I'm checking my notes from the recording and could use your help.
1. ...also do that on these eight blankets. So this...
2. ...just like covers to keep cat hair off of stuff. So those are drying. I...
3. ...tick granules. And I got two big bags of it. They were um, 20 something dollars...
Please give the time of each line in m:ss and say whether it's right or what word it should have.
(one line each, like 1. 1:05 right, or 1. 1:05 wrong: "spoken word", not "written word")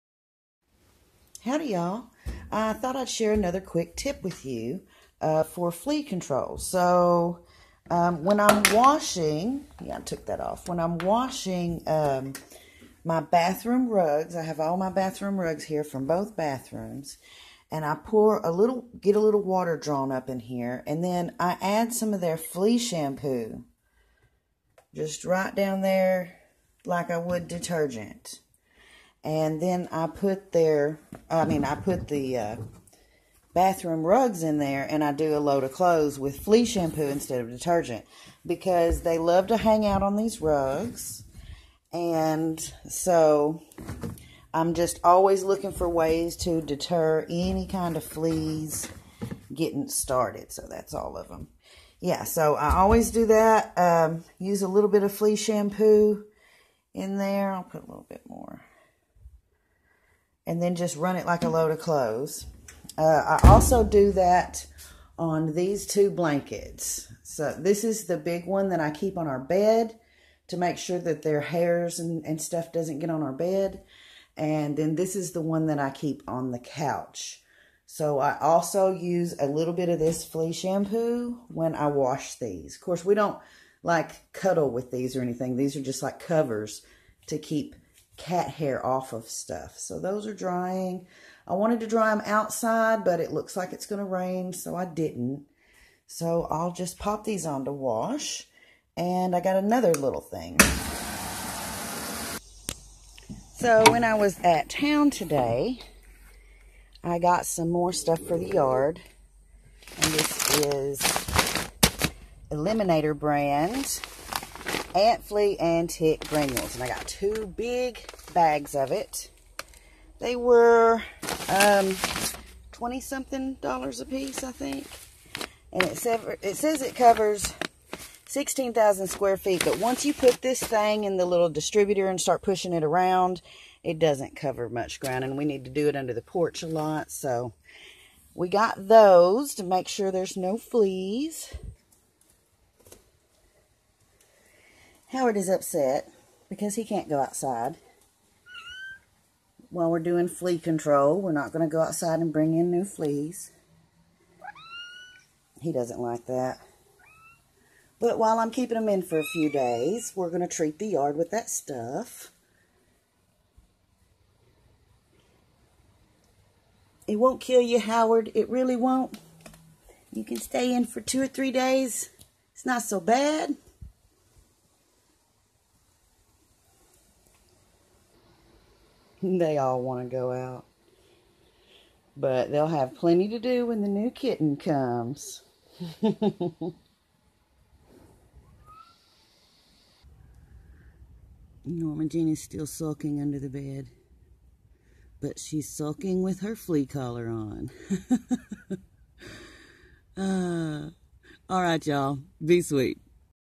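1. 1:03 wrong: "two", not "eight"
2. 1:25 right
3. 1:55 right.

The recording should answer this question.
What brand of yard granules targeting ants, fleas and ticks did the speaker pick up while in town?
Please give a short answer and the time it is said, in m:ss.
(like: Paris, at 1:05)
Eliminator, at 1:52.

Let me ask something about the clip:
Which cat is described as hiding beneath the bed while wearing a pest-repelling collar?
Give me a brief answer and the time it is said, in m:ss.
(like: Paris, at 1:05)
Norma Jean, at 3:11.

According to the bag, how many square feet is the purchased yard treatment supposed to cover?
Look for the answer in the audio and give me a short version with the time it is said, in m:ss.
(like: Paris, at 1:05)
16,000, at 2:08.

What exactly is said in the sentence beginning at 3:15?
But she's sulking with her flea collar on.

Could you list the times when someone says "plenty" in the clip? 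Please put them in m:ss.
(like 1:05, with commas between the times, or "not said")
3:02.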